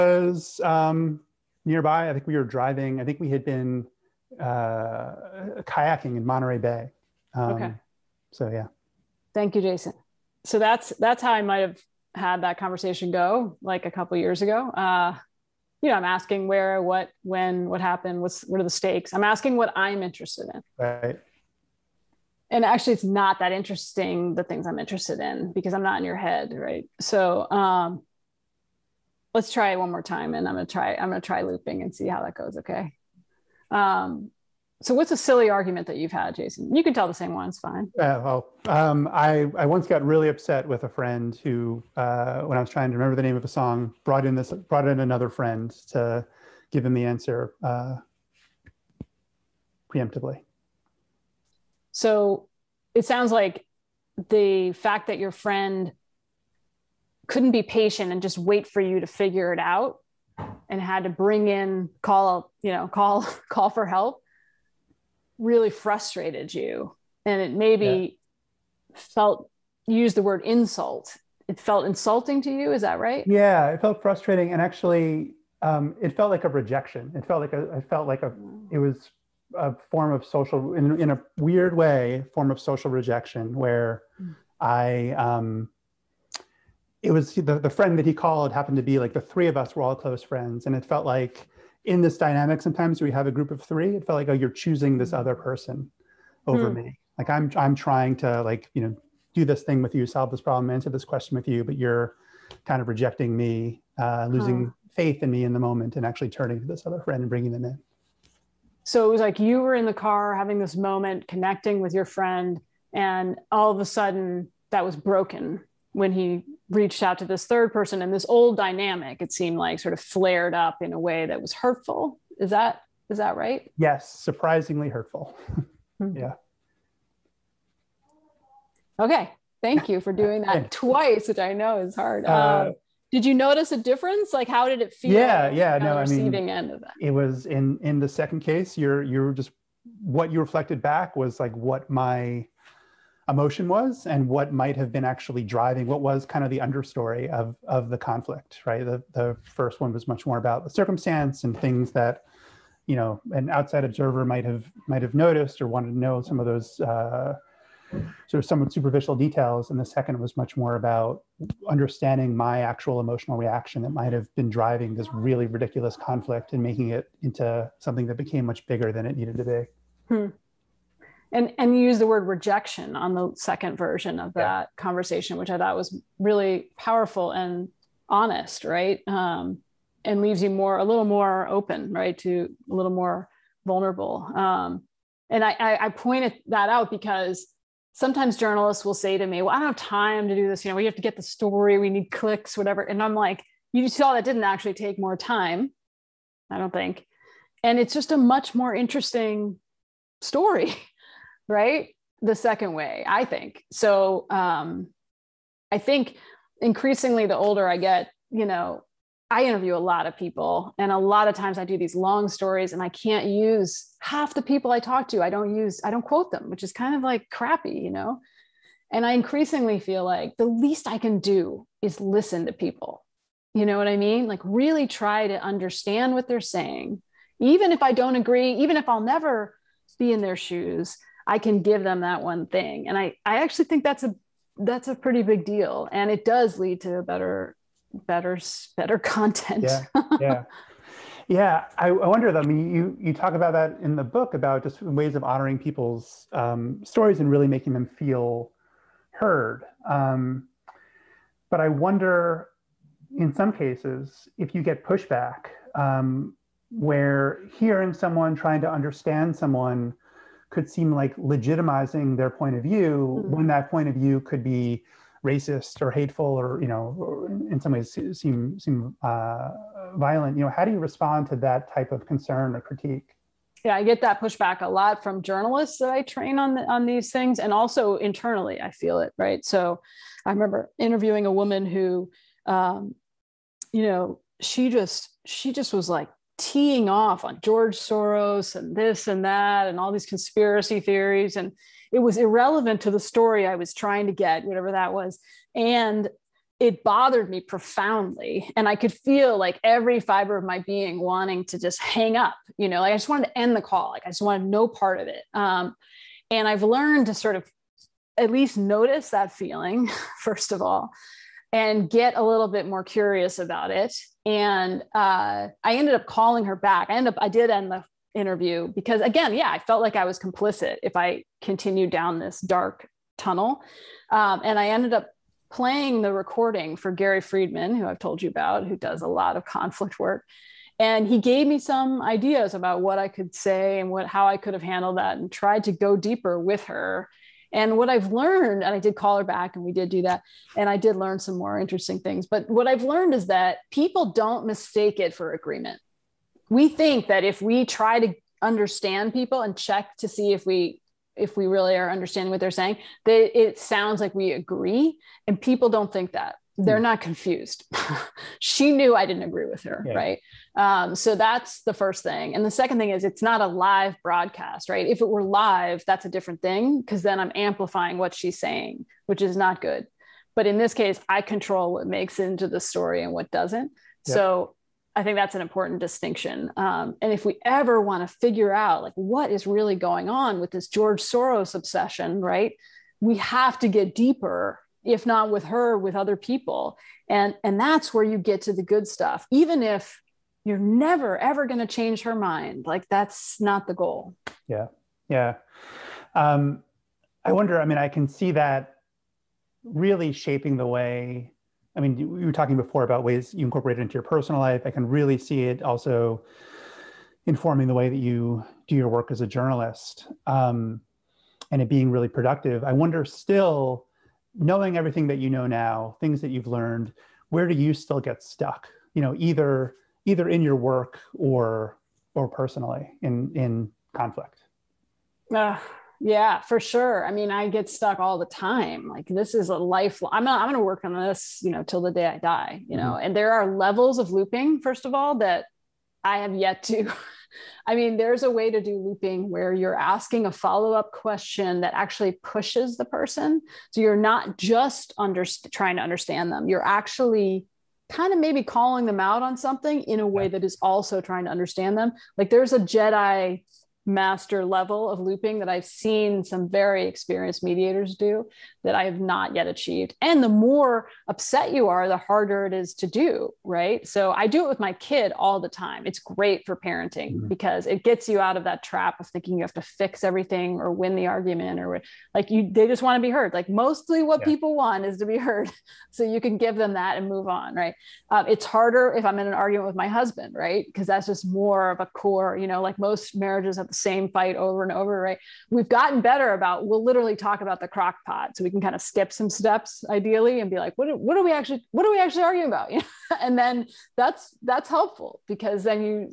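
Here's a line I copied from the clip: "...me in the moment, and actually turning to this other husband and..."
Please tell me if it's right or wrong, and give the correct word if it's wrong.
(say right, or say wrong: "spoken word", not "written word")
wrong: "friend", not "husband".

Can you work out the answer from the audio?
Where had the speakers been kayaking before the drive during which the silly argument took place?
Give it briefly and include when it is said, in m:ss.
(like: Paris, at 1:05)
Monterey Bay, at 0:06.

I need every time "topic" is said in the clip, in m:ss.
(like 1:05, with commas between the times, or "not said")
not said.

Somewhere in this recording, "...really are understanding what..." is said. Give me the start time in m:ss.
5:51.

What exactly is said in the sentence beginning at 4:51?
And it was irrelevant to the story I was trying to get, whatever that was.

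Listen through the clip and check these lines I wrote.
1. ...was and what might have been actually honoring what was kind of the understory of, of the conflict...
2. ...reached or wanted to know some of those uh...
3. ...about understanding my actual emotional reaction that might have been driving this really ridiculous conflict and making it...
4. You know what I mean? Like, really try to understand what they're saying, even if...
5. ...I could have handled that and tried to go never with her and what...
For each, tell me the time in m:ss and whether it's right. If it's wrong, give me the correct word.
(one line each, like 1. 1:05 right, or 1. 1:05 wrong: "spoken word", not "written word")
1. 2:23 wrong: "driving", not "honoring"
2. 2:35 wrong: "noticed", not "reached"
3. 2:40 right
4. 3:43 right
5. 5:34 wrong: "deeper", not "never".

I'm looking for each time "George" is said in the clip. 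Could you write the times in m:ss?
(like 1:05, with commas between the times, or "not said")
4:47, 6:20.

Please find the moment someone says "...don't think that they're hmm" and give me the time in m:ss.
5:55.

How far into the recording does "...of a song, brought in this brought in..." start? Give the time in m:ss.
0:43.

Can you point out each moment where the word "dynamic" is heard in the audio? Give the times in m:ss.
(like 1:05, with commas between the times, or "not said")
1:32, 1:58.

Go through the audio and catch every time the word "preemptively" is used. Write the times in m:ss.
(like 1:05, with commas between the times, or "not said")
0:49.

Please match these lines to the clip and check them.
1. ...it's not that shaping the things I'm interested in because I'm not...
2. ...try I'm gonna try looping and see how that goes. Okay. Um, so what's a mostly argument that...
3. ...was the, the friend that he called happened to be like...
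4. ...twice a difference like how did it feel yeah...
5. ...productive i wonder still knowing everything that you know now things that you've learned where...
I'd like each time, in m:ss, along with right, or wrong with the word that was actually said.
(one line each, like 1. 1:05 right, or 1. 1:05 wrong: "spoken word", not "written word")
1. 0:22 wrong: "interesting", not "shaping"
2. 0:30 wrong: "silly", not "mostly"
3. 1:27 right
4. 2:13 wrong: "notice", not "twice"
5. 6:52 right.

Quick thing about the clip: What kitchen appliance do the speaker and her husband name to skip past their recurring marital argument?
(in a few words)
crock pot.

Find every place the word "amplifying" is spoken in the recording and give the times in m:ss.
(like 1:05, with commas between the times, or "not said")
6:07.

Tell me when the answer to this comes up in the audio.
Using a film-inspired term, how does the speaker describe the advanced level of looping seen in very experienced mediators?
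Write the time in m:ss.
7:32.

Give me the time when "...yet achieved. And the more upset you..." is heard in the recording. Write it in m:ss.
7:39.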